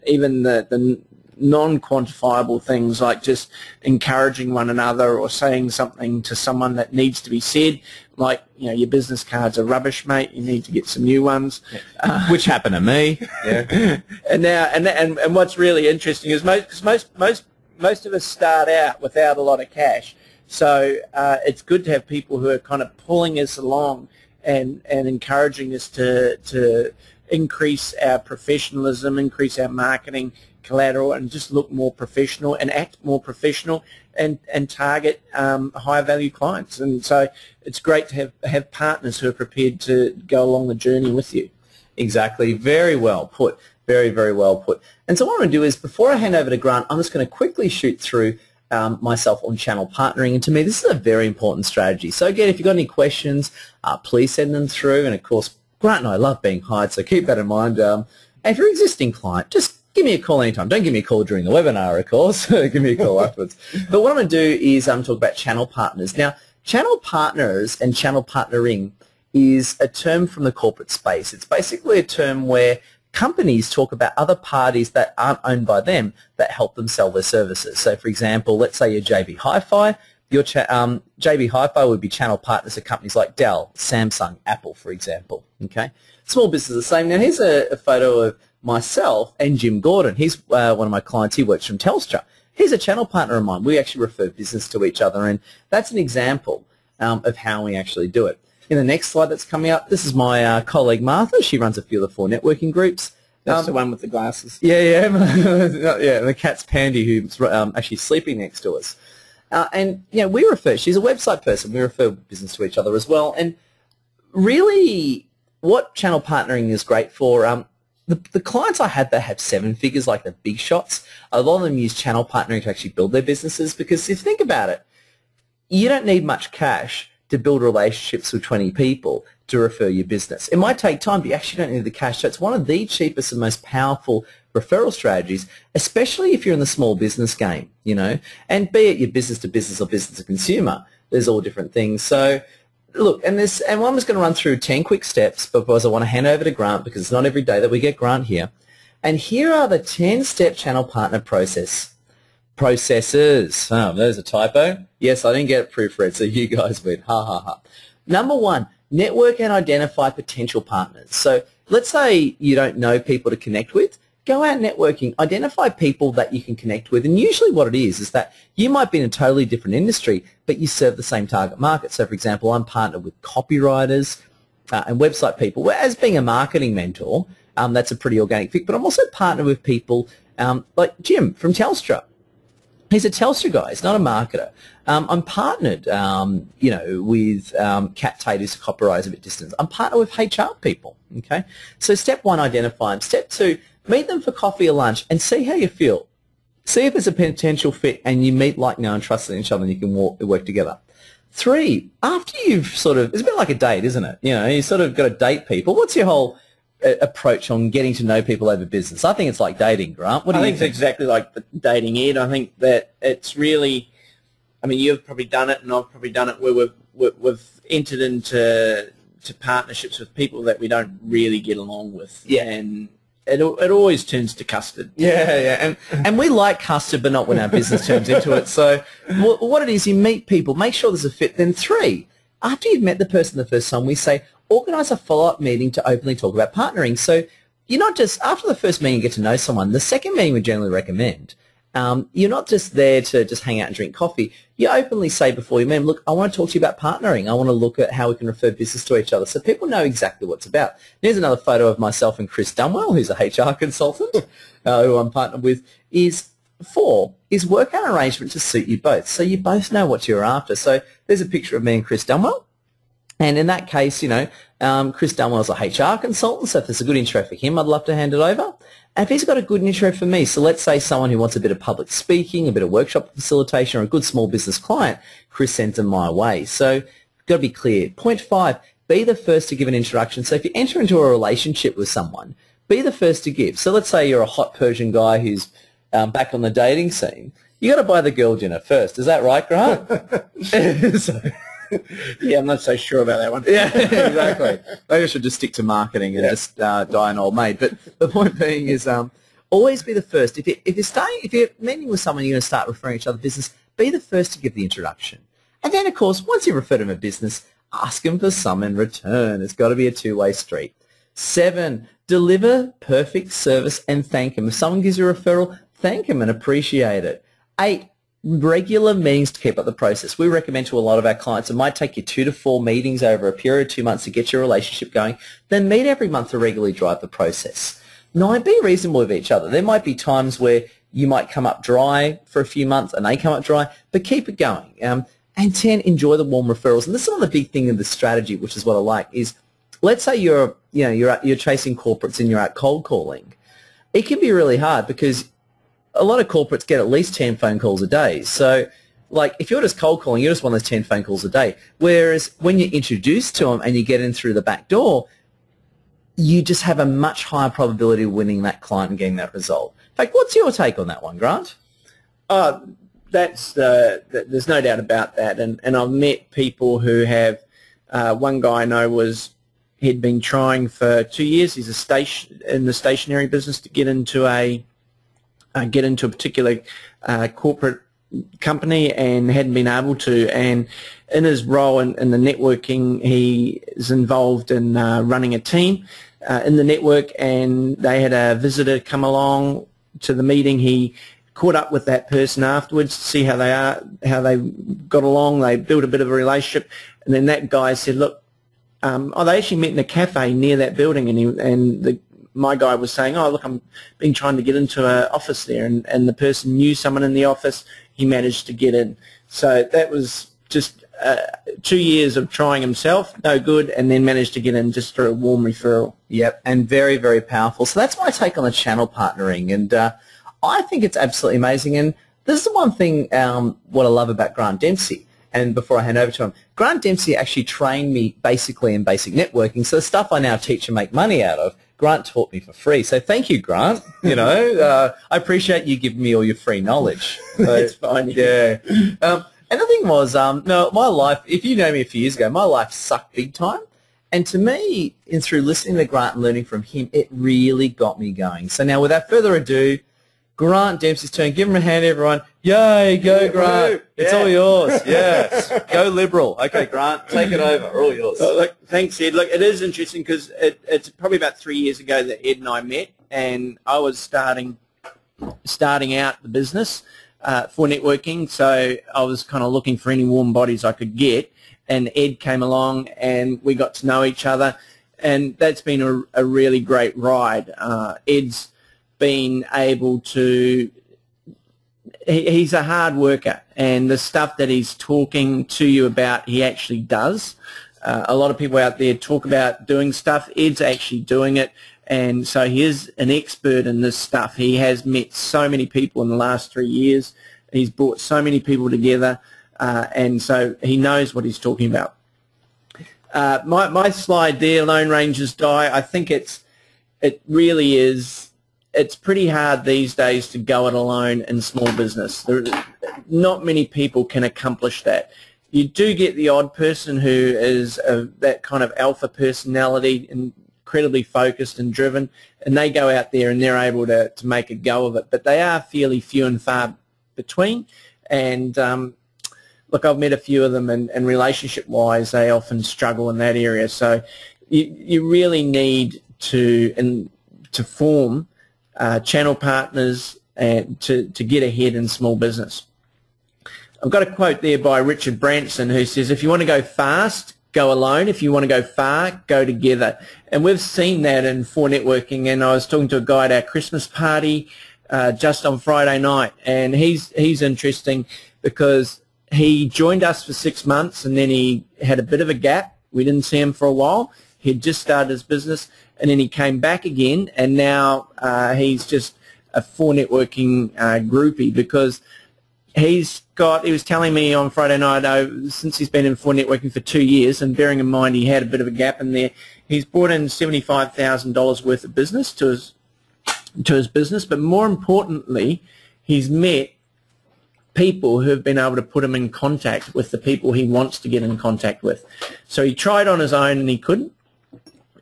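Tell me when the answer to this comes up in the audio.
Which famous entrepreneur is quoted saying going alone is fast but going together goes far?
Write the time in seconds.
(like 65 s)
544 s.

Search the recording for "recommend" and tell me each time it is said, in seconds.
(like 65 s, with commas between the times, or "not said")
240 s, 320 s.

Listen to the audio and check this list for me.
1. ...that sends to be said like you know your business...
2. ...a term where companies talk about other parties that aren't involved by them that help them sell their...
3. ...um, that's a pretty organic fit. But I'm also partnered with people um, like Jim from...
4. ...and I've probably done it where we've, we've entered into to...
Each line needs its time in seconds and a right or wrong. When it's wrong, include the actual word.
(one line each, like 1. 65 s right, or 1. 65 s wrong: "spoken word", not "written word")
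1. 6 s wrong: "needs", not "sends"
2. 71 s wrong: "owned", not "involved"
3. 177 s right
4. 215 s right.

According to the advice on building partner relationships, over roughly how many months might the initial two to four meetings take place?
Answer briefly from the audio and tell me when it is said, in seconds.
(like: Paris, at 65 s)
2 months, at 323 s.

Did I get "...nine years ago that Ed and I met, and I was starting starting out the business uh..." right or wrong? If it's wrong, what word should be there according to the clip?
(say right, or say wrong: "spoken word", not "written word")
wrong: "three", not "nine".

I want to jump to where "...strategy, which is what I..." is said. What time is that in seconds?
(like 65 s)
337 s.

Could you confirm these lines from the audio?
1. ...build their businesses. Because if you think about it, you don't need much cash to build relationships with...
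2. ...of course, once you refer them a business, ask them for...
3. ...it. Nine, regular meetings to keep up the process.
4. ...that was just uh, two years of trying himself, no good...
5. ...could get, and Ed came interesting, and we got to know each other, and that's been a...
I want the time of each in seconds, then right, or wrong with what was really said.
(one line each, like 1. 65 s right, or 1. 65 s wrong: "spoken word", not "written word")
1. 122 s right
2. 305 s right
3. 317 s wrong: "Eight", not "Nine"
4. 409 s right
5. 470 s wrong: "along", not "interesting".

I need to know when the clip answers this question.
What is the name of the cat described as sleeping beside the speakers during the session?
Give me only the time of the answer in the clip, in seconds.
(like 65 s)
106 s.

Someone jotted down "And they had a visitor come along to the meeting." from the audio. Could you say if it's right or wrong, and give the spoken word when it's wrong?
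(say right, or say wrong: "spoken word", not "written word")
right.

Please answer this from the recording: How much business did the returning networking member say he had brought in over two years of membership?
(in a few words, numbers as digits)
$75,000.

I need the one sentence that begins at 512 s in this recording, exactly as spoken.
There, not many people can accomplish that.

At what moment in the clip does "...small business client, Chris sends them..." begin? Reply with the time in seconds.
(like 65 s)
274 s.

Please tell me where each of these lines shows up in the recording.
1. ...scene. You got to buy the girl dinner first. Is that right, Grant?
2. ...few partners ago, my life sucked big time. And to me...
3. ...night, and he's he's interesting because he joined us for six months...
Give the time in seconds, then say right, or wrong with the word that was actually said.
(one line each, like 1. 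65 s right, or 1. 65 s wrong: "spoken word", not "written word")
1. 286 s right
2. 441 s wrong: "years", not "partners"
3. 555 s right.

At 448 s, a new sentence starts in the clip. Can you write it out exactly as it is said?
So now without further ado, Grant Dempsey's turn.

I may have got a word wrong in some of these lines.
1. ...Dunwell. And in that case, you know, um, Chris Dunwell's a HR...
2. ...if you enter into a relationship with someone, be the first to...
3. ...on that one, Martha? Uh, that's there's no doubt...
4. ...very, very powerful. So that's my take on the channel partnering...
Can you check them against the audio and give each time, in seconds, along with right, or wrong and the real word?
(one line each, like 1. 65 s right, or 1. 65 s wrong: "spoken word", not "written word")
1. 262 s right
2. 280 s right
3. 360 s wrong: "Grant", not "Martha"
4. 416 s right.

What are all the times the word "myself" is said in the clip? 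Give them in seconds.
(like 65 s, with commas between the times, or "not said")
48 s, 88 s, 251 s.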